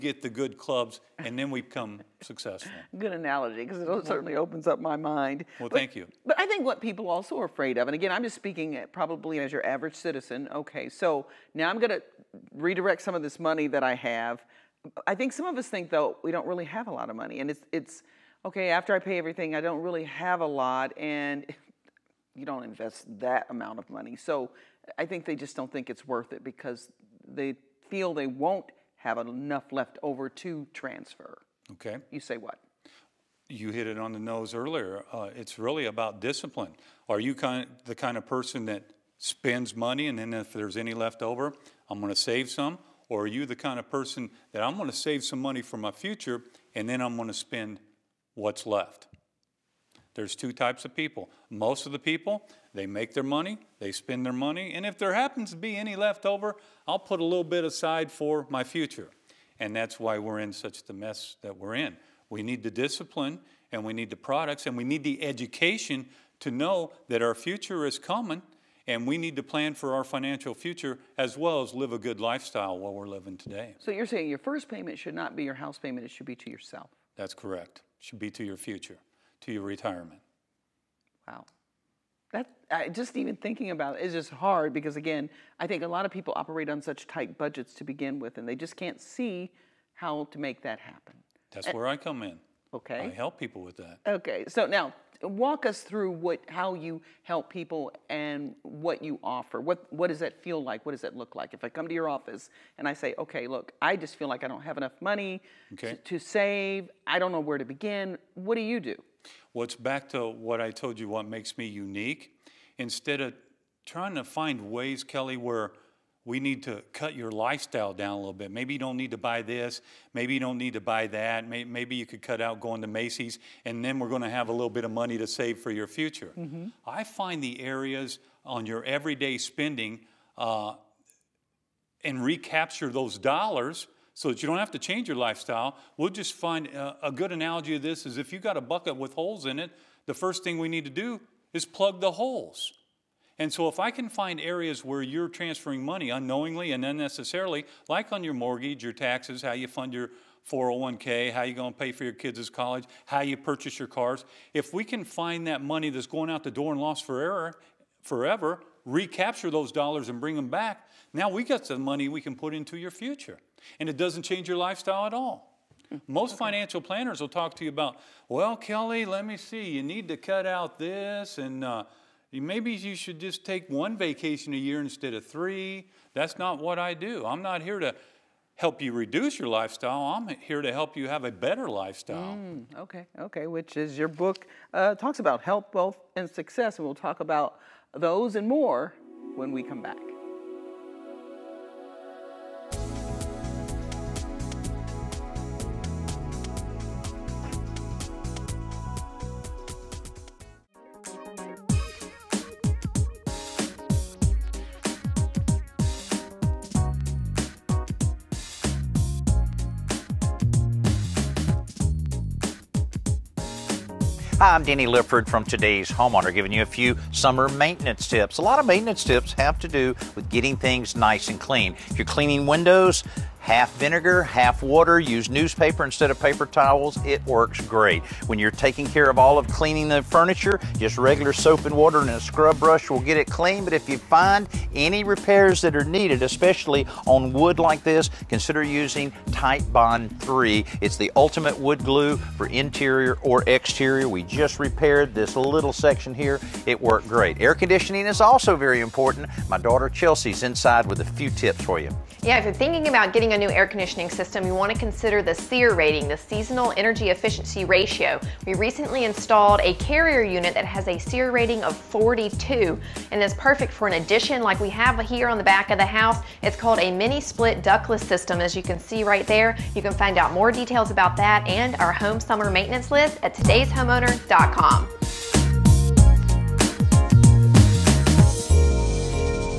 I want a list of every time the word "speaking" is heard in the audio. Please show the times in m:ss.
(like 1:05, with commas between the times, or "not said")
0:08.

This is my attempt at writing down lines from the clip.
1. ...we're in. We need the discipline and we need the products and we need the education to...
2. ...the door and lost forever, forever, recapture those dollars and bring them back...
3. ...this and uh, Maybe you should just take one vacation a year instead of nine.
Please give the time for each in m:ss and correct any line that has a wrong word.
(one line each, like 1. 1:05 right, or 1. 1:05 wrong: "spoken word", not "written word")
1. 1:01 right
2. 2:36 right
3. 2:50 wrong: "three", not "nine".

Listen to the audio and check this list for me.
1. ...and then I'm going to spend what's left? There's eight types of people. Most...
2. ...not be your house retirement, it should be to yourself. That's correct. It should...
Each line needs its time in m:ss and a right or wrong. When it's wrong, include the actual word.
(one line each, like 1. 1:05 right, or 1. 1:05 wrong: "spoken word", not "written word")
1. 0:46 wrong: "two", not "eight"
2. 1:15 wrong: "payment", not "retirement".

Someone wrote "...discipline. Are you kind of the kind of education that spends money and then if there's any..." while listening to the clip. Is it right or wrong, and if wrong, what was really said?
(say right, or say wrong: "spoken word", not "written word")
wrong: "person", not "education".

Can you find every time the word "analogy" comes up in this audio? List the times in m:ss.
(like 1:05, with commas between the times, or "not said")
0:03, 2:17.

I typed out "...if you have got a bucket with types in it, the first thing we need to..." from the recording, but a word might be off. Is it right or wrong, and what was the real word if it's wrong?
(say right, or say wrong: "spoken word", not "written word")
wrong: "holes", not "types".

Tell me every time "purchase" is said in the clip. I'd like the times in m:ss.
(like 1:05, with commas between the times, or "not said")
2:33.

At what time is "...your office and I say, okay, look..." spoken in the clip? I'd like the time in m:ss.
1:41.